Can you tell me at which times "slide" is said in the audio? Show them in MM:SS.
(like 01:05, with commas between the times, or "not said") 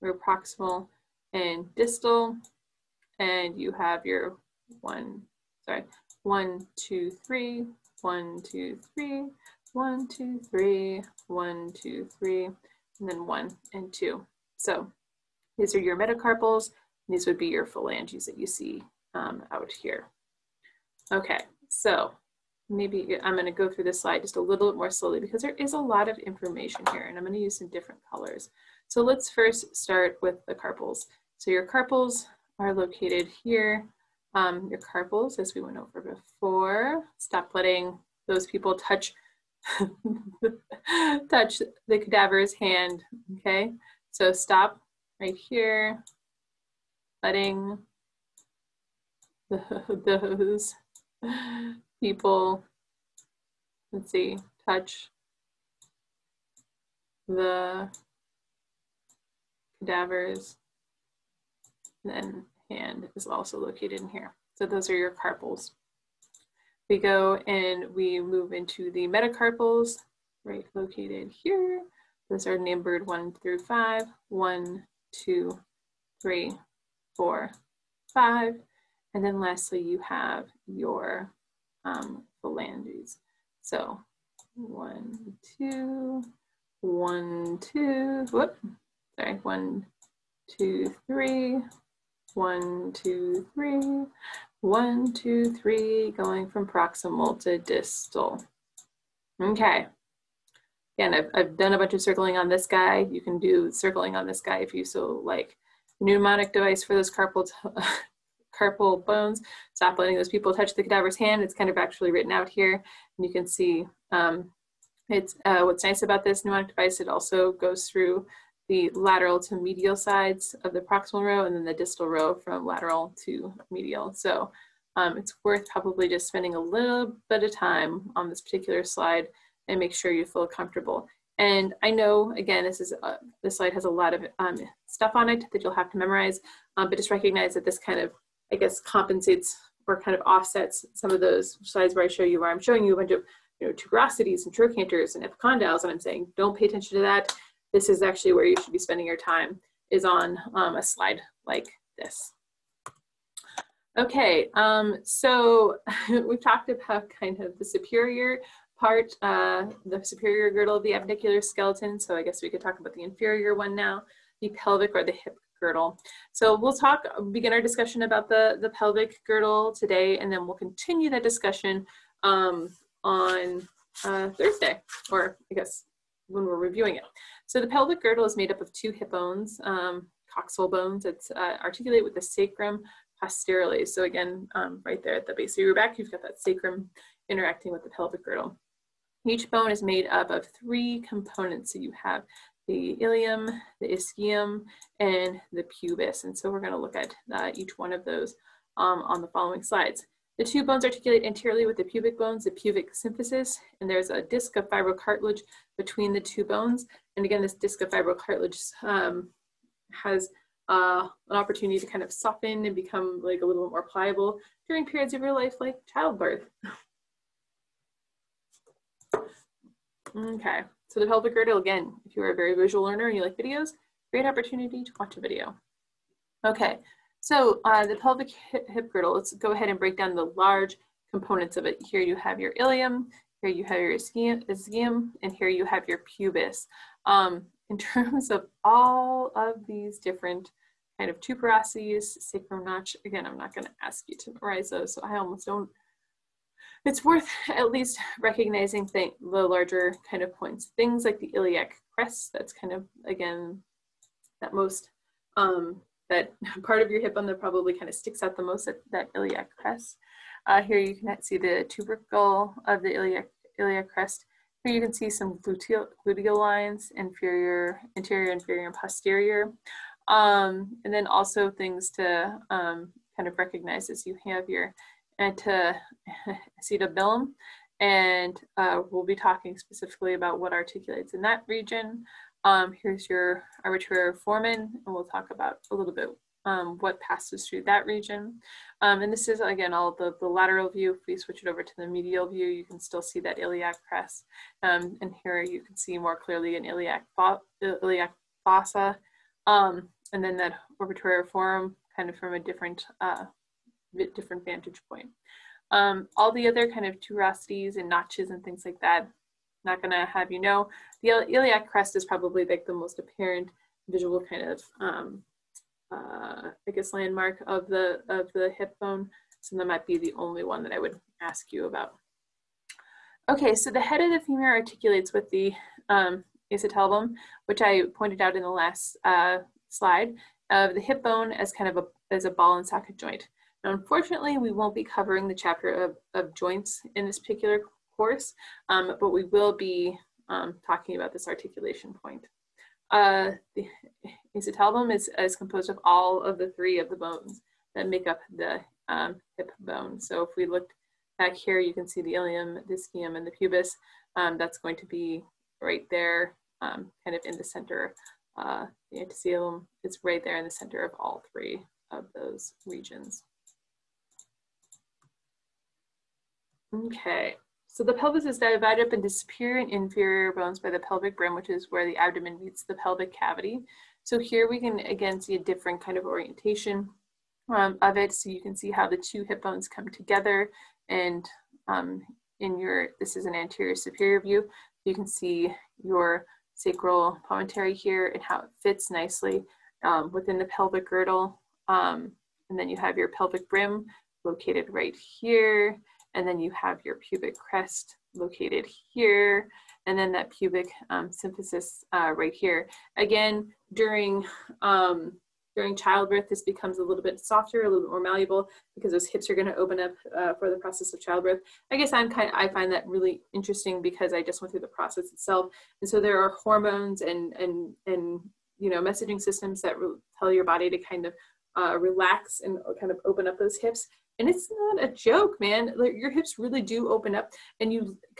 00:24, 02:08, 02:13, 02:21, 02:30, 03:19, 05:29.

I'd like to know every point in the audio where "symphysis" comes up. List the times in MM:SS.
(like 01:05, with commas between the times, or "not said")
03:22, 06:41.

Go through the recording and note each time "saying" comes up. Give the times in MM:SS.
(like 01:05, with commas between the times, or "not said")
02:25.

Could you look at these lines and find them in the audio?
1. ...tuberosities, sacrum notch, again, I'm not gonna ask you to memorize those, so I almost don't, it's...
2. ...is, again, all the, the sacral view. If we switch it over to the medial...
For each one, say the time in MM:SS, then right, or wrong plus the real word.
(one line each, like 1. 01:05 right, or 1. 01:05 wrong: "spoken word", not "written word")
1. 04:01 right
2. 04:49 wrong: "lateral", not "sacral".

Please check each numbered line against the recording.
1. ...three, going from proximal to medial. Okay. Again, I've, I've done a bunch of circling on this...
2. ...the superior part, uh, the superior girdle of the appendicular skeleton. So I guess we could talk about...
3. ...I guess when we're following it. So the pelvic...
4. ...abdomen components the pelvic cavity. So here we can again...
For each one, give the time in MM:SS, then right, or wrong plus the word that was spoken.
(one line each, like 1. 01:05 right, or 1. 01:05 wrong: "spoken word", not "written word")
1. 01:35 wrong: "distal", not "medial"
2. 02:37 right
3. 02:55 wrong: "reviewing", not "following"
4. 06:11 wrong: "meets", not "components".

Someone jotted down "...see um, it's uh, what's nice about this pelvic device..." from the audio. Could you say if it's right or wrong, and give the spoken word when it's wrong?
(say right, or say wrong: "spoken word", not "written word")
wrong: "mnemonic", not "pelvic".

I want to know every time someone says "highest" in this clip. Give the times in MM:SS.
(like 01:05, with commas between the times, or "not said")
not said.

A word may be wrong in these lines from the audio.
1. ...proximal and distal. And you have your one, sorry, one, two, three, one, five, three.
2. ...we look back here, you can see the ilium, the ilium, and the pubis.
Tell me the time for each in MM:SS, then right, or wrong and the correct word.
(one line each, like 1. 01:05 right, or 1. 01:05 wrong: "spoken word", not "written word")
1. 00:00 wrong: "two", not "five"
2. 05:50 wrong: "ischium", not "ilium".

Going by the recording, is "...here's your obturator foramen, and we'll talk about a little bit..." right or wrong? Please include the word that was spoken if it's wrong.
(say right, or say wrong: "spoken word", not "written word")
right.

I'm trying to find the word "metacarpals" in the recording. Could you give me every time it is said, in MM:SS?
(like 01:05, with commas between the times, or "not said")
00:15, 01:09.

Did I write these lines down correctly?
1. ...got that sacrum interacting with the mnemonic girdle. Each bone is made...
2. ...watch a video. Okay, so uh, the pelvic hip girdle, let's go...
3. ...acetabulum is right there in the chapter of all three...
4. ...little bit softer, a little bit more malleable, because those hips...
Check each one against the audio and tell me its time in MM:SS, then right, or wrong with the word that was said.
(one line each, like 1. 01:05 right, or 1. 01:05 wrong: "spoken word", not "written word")
1. 03:06 wrong: "pelvic", not "mnemonic"
2. 03:45 right
3. 05:59 wrong: "center", not "chapter"
4. 06:46 right.